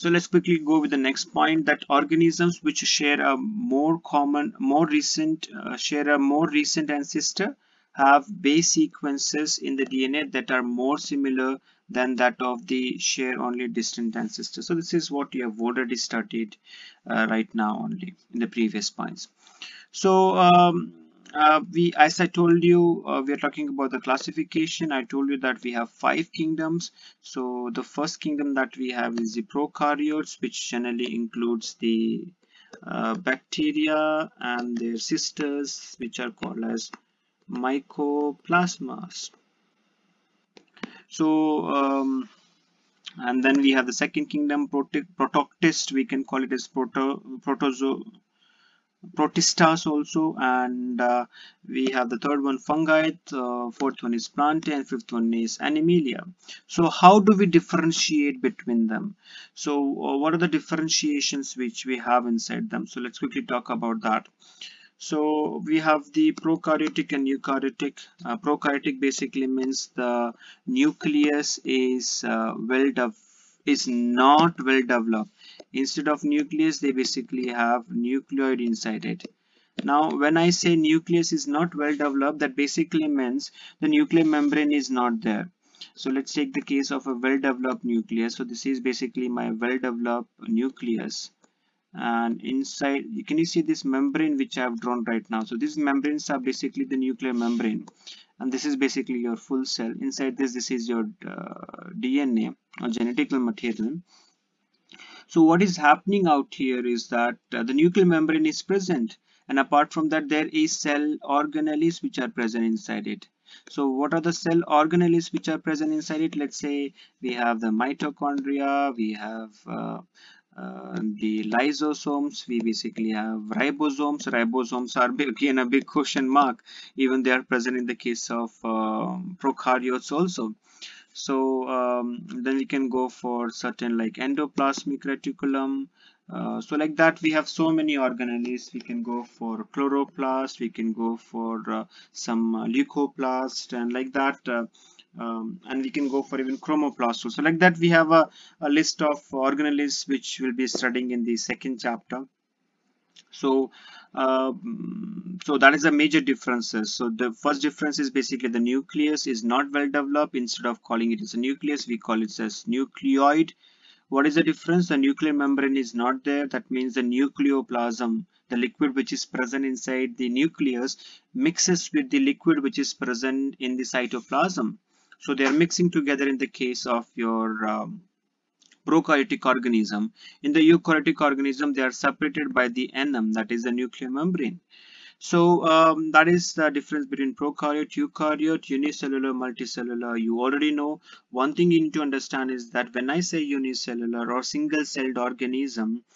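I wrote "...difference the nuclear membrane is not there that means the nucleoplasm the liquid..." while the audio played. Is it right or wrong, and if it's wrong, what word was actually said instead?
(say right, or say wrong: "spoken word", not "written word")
right.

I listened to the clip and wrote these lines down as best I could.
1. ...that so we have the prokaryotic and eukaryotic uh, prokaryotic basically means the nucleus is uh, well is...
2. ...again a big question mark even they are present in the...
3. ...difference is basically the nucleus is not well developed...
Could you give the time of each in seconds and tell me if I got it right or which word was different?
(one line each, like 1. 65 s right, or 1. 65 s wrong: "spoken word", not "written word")
1. 64 s right
2. 125 s right
3. 157 s right.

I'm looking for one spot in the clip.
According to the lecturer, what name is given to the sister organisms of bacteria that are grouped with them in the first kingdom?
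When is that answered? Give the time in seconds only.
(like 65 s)
37 s.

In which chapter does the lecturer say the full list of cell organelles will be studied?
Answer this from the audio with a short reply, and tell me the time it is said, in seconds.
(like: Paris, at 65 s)
Second chapter, at 151 s.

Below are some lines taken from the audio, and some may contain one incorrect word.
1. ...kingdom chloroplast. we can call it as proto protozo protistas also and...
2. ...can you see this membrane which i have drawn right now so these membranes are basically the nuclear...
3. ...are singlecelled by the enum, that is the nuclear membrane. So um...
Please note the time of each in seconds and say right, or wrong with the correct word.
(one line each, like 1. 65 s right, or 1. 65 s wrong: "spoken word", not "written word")
1. 44 s wrong: "protist", not "chloroplast"
2. 93 s right
3. 181 s wrong: "separated", not "singlecelled".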